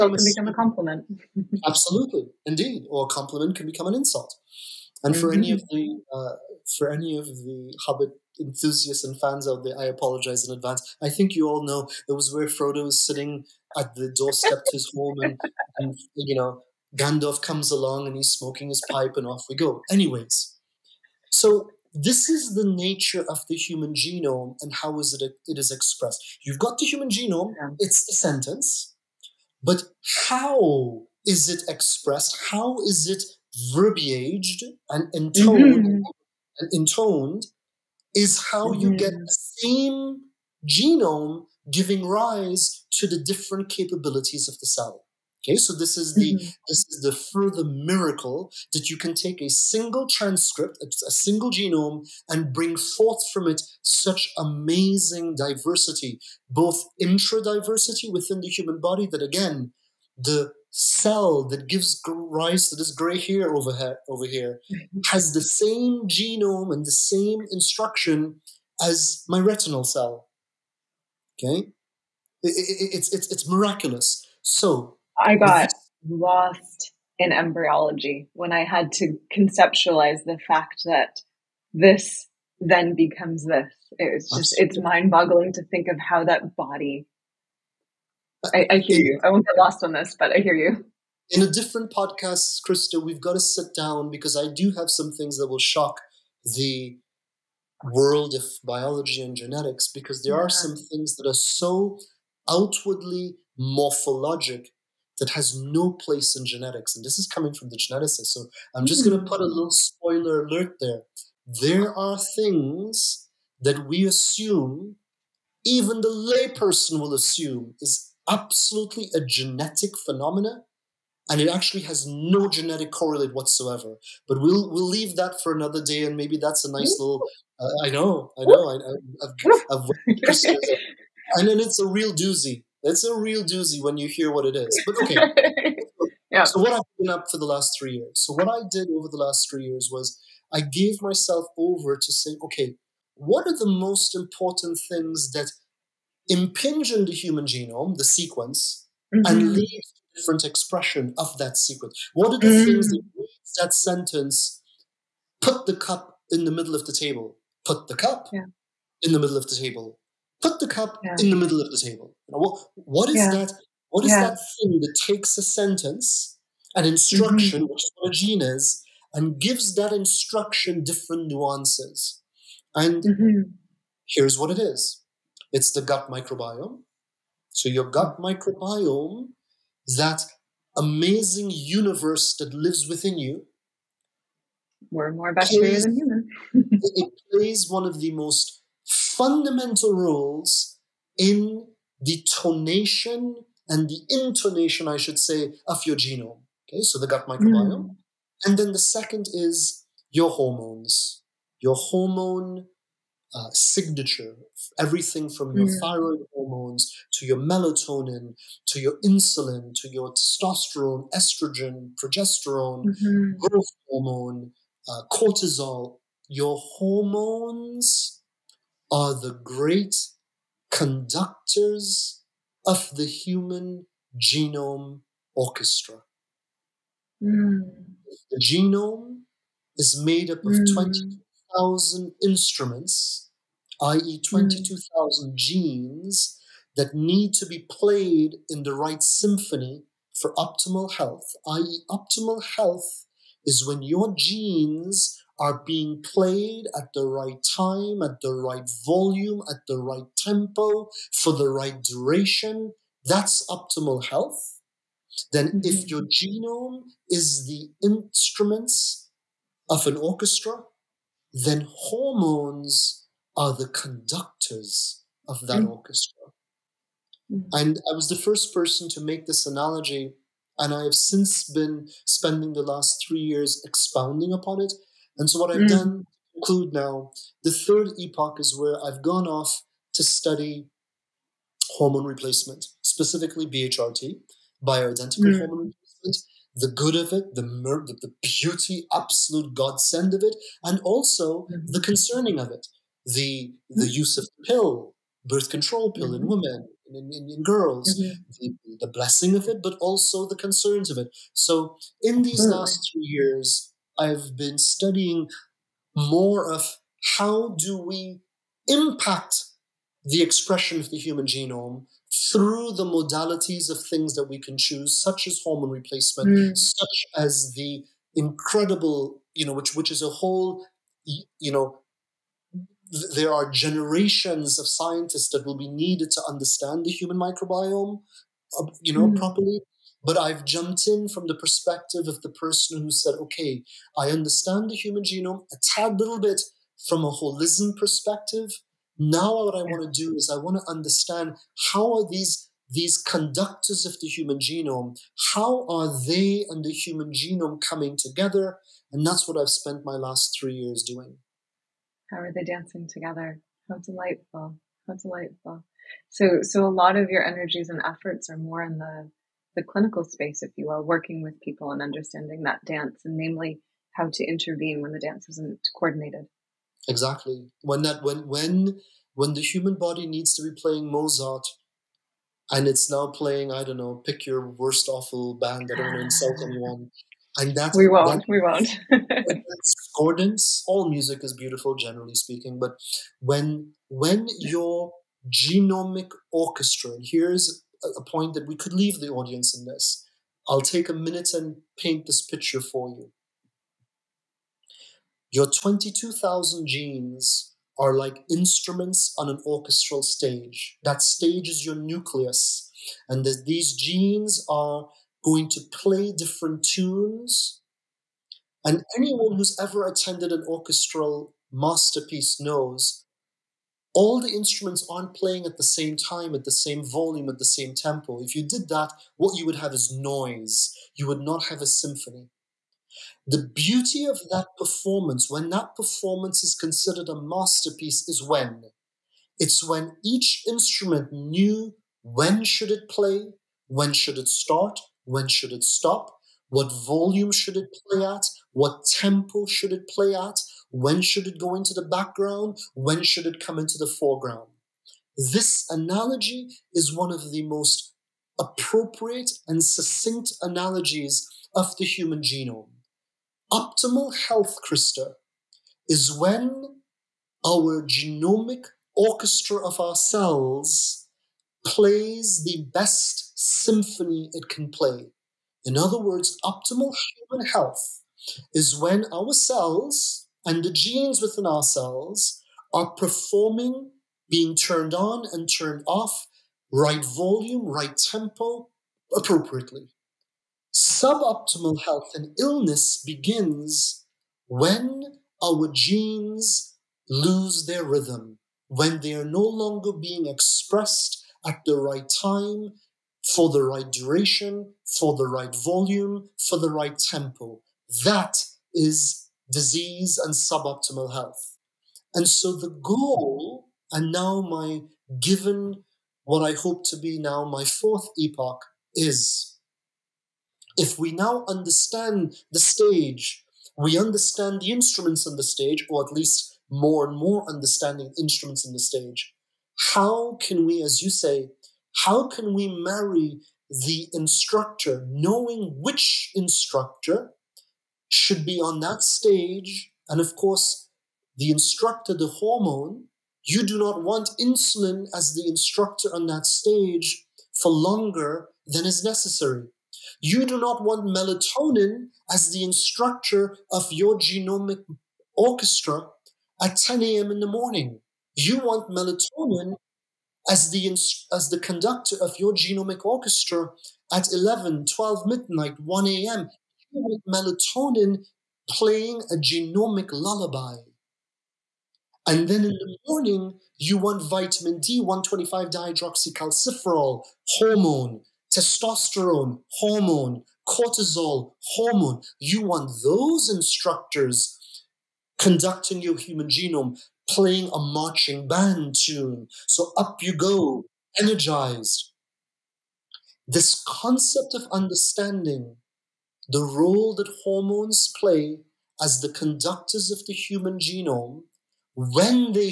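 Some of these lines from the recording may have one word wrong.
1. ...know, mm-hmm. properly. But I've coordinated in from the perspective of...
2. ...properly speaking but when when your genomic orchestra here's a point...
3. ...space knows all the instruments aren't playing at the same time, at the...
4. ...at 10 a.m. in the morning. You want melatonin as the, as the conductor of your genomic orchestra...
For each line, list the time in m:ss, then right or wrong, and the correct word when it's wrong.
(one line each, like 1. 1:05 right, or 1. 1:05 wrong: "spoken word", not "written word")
1. 5:28 wrong: "jumped", not "coordinated"
2. 6:21 wrong: "generally", not "properly"
3. 6:51 wrong: "masterpiece", not "space"
4. 9:06 right.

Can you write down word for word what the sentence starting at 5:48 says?
And that's what I've spent my last three years doing.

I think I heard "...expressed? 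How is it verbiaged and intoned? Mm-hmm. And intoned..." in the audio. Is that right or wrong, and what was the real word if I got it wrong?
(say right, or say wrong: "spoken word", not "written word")
right.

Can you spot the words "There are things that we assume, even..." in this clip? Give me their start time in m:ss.
1:51.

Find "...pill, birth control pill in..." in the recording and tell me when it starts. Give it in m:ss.
4:54.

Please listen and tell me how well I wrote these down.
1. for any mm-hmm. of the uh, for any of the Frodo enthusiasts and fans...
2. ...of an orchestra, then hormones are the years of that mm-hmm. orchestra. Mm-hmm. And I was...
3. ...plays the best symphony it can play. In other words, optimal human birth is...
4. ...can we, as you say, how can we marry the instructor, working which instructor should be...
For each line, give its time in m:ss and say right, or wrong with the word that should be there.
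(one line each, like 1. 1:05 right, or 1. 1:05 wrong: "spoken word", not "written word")
1. 0:05 wrong: "Hobbit", not "Frodo"
2. 4:19 wrong: "conductors", not "years"
3. 7:41 wrong: "health", not "birth"
4. 8:40 wrong: "knowing", not "working".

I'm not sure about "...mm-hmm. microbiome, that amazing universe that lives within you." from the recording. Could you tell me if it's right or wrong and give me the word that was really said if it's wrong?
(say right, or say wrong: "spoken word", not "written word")
right.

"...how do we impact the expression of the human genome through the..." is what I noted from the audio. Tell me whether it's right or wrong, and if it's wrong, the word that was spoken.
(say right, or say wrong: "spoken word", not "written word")
right.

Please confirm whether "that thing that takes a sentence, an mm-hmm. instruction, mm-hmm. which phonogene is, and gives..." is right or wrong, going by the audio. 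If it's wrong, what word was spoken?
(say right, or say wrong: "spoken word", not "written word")
right.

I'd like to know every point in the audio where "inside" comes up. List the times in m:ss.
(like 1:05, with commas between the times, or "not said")
not said.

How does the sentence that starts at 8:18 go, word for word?
That is disease and suboptimal health.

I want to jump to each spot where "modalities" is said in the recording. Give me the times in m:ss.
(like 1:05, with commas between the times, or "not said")
5:12.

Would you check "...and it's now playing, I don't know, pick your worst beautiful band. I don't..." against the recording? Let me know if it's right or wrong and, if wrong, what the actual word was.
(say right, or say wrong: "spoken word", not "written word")
wrong: "awful", not "beautiful".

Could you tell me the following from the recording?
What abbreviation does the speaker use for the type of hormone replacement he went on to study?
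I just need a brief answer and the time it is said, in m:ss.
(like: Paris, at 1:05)
BHRT, at 4:43.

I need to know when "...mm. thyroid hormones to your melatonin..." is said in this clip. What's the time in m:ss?
3:25.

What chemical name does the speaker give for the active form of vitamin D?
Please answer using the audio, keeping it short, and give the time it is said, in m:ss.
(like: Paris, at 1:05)
1,25-dihydroxycalciferol, at 9:25.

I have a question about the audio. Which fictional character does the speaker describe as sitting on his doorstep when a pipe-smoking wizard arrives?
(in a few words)
Frodo.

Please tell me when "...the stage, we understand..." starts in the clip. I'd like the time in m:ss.
8:32.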